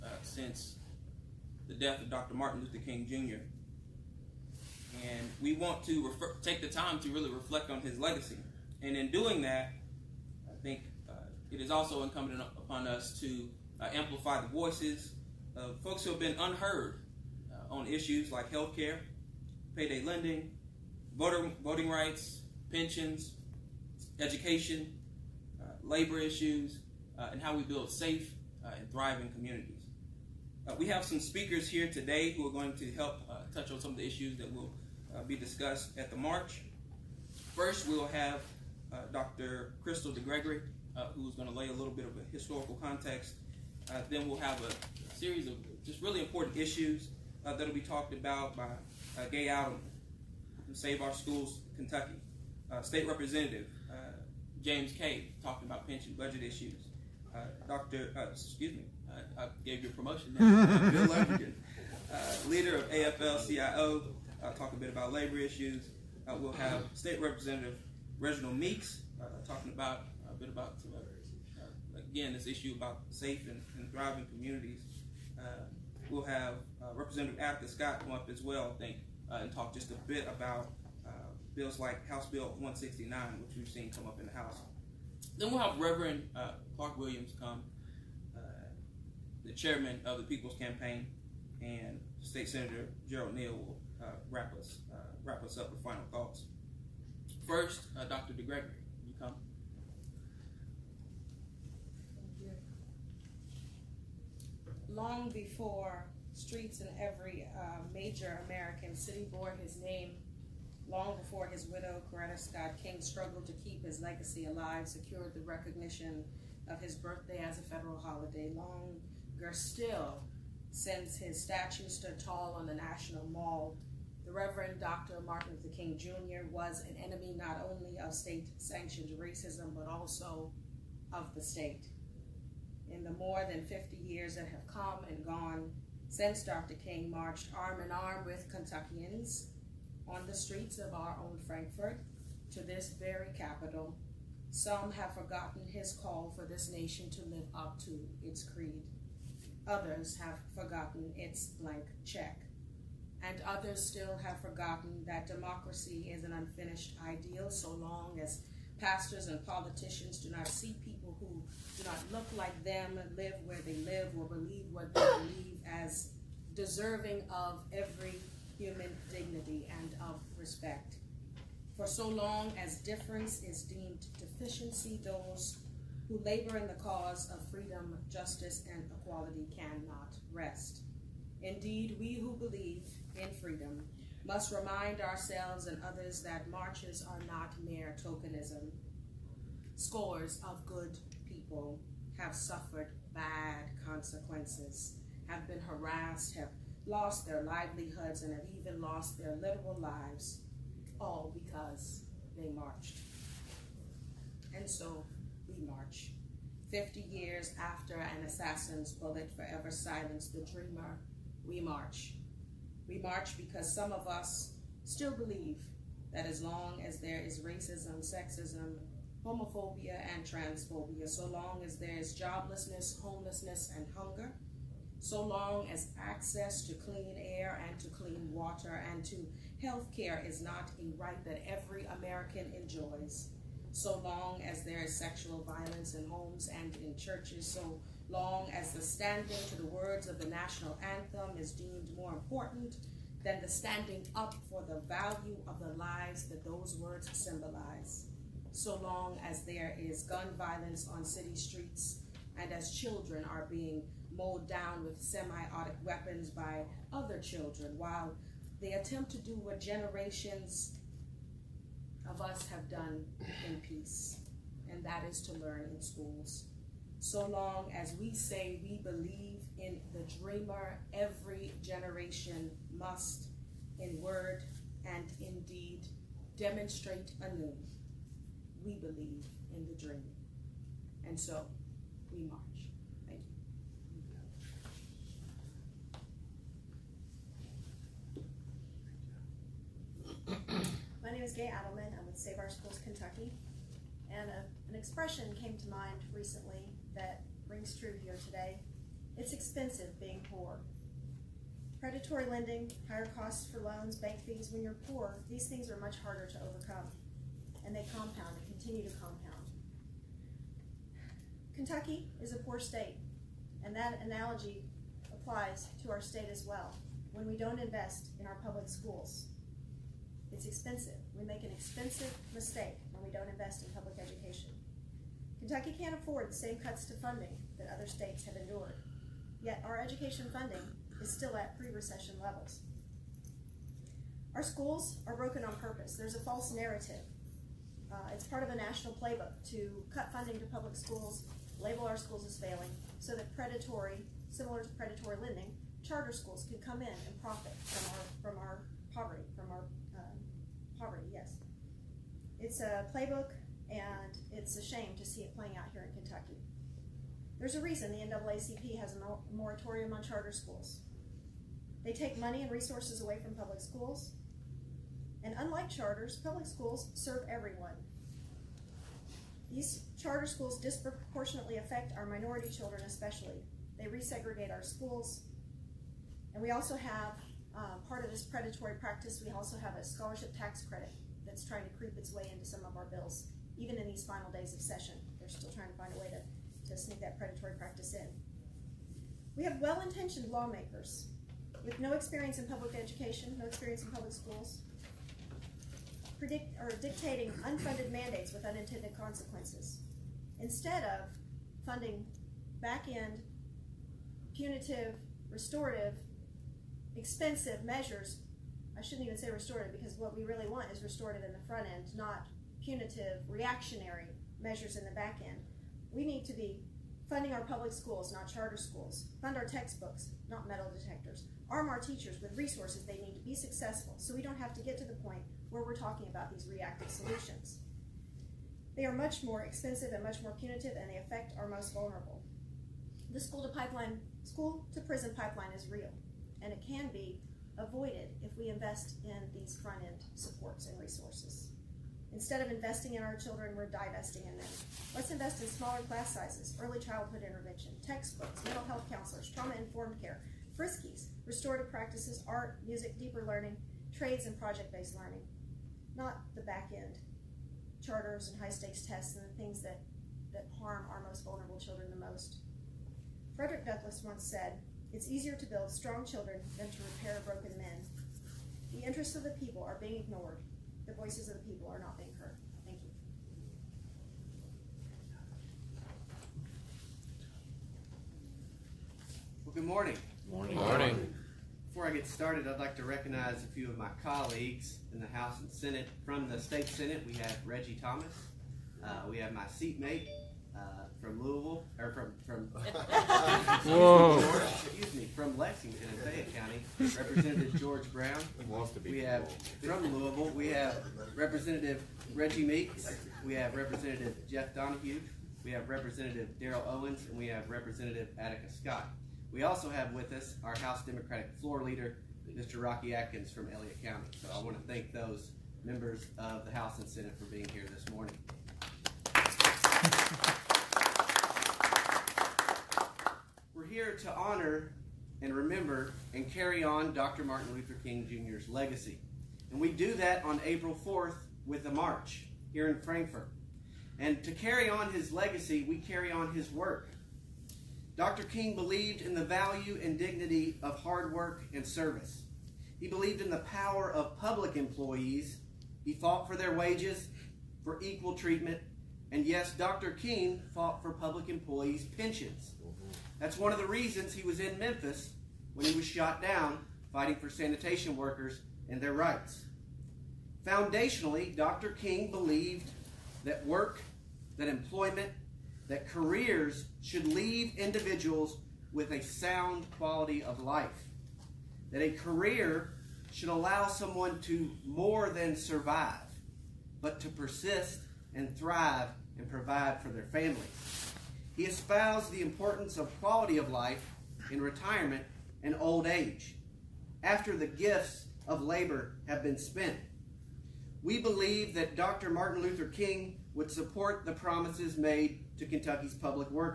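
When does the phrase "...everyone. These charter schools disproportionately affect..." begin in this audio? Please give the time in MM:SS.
06:07.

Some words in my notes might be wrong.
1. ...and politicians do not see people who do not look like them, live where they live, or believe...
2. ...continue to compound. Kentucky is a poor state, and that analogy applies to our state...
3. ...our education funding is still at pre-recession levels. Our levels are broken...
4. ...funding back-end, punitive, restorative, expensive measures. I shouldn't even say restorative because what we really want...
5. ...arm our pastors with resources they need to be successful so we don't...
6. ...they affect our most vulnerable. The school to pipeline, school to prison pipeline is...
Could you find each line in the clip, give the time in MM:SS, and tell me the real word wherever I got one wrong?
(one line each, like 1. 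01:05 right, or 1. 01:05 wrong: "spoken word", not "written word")
1. 02:39 right
2. 05:08 right
3. 05:29 wrong: "schools", not "levels"
4. 06:41 right
5. 07:01 wrong: "teachers", not "pastors"
6. 07:10 right.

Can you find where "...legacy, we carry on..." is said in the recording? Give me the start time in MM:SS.
08:55.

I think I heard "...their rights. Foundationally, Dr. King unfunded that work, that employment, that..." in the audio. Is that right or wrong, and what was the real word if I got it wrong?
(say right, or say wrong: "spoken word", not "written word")
wrong: "believed", not "unfunded".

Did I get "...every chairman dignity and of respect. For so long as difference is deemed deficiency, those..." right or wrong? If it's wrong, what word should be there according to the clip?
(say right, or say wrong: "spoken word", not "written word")
wrong: "human", not "chairman".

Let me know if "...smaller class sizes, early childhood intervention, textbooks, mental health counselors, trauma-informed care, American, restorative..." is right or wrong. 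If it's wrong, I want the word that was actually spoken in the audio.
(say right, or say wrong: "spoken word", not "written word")
wrong: "FRYSCs", not "American".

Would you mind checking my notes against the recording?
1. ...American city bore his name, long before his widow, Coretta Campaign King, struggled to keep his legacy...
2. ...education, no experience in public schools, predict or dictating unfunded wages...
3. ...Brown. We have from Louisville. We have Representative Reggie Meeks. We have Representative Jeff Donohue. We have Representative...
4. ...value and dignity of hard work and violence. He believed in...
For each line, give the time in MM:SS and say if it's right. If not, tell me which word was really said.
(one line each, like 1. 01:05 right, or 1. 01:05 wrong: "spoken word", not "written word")
1. 01:48 wrong: "Scott", not "Campaign"
2. 06:32 wrong: "mandates", not "wages"
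3. 08:17 right
4. 08:59 wrong: "service", not "violence".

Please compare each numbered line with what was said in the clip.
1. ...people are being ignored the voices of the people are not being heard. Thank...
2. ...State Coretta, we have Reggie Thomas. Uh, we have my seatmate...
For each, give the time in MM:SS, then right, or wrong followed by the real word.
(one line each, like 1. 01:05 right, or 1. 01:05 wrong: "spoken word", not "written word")
1. 07:49 right
2. 08:06 wrong: "Senate", not "Coretta".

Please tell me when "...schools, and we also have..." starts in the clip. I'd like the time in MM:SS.
06:14.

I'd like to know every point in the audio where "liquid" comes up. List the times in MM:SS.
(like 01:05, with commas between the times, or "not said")
not said.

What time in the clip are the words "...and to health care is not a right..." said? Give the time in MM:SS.
03:48.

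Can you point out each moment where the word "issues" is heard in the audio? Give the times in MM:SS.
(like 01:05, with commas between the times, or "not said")
00:17, 00:26, 00:34, 00:46, 00:56, 01:05, 01:12.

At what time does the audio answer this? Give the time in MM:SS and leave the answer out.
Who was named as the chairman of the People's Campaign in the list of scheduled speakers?
01:26.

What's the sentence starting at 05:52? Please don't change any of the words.
It's a playbook and it's a shame to see it playing out here in Kentucky.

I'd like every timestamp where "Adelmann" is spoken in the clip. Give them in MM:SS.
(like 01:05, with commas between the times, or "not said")
00:49, 04:51.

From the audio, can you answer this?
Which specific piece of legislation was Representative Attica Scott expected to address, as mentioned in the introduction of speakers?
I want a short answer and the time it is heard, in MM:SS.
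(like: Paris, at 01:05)
House Bill 169, at 01:22.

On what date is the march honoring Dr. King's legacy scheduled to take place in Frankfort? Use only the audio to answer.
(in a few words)
April 4th.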